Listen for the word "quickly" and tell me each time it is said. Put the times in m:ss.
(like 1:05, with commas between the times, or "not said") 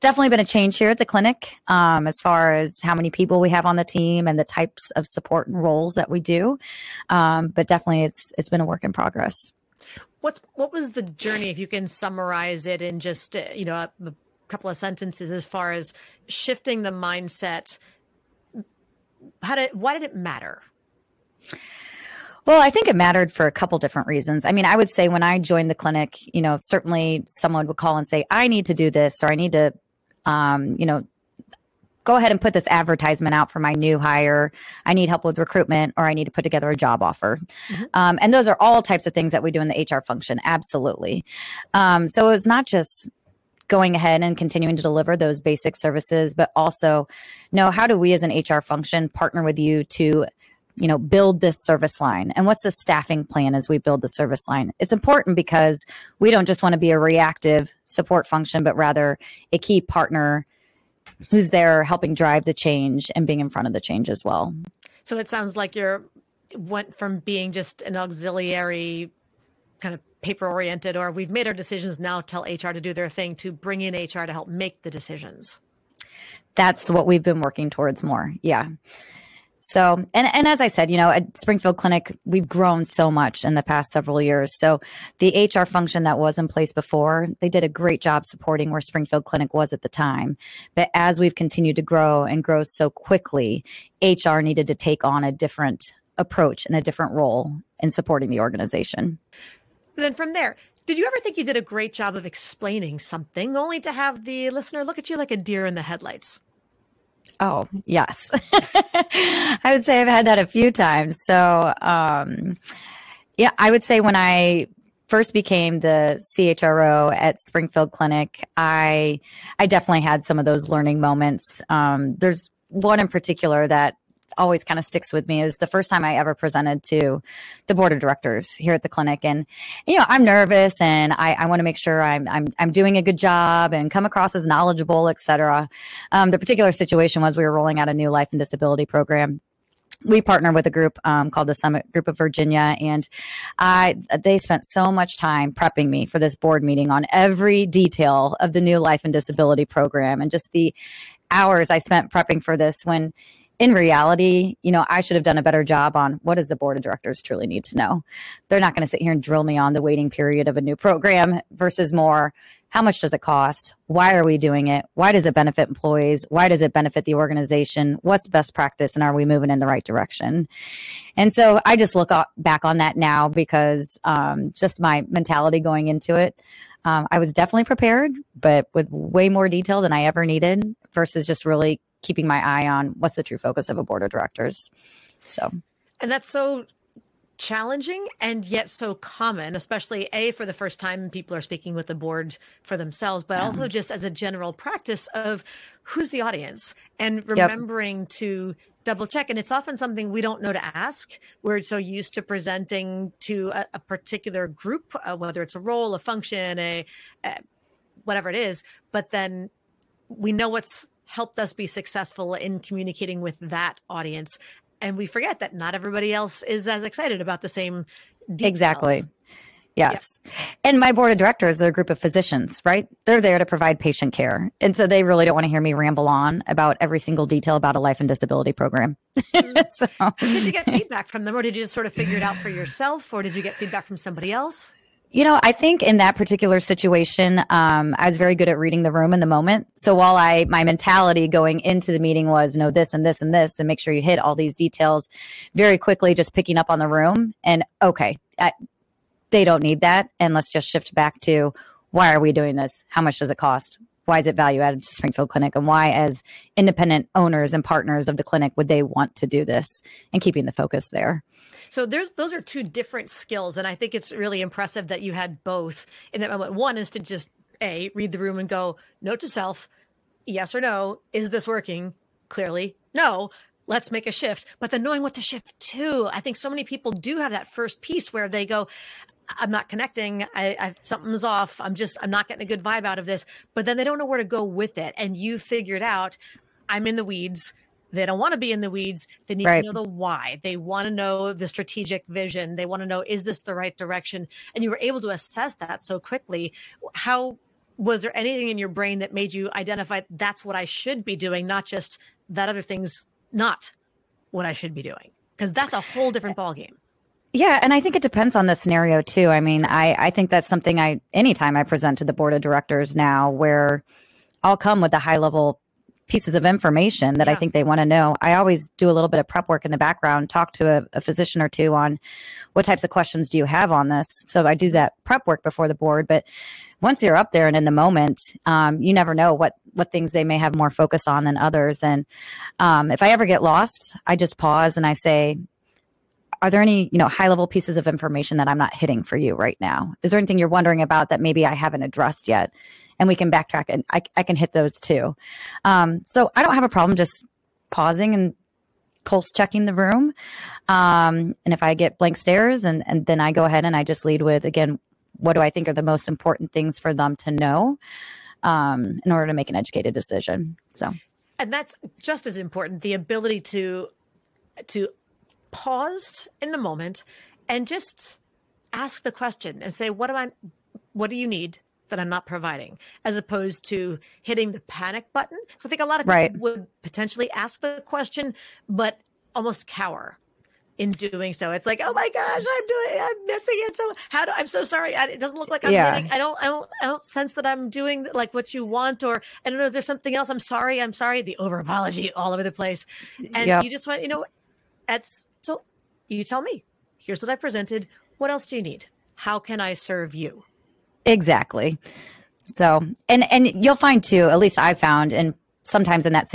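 1:32, 4:05, 4:55.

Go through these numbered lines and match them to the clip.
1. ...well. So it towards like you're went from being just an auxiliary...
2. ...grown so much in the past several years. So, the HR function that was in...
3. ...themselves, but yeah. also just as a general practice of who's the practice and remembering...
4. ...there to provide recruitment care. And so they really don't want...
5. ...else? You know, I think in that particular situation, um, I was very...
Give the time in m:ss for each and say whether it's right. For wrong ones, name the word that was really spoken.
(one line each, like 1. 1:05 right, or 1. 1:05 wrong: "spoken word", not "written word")
1. 1:04 wrong: "sounds", not "towards"
2. 1:22 right
3. 3:12 wrong: "audience", not "practice"
4. 3:43 wrong: "patient", not "recruitment"
5. 3:54 right.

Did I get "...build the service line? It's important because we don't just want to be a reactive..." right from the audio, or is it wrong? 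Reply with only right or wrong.
right.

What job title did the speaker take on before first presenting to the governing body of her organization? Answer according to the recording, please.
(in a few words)
CHRO.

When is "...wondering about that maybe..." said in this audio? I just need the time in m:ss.
5:40.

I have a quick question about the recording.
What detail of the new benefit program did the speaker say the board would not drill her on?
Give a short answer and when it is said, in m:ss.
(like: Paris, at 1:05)
Waiting period, at 2:39.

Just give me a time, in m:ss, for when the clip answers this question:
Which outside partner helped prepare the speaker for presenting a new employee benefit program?
2:21.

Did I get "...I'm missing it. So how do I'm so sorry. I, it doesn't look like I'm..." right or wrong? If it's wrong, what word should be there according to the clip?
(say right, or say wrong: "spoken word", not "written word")
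right.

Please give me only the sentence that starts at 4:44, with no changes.
And you figured out I'm in the weeds.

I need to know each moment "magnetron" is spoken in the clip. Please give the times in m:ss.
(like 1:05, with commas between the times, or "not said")
not said.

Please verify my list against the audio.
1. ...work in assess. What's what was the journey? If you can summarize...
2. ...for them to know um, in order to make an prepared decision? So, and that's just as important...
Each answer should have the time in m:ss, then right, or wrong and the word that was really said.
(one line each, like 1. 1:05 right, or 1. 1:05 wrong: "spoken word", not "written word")
1. 0:08 wrong: "progress", not "assess"
2. 5:56 wrong: "educated", not "prepared".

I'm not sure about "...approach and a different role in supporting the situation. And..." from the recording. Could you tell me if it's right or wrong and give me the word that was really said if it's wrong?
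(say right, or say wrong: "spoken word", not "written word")
wrong: "organization", not "situation".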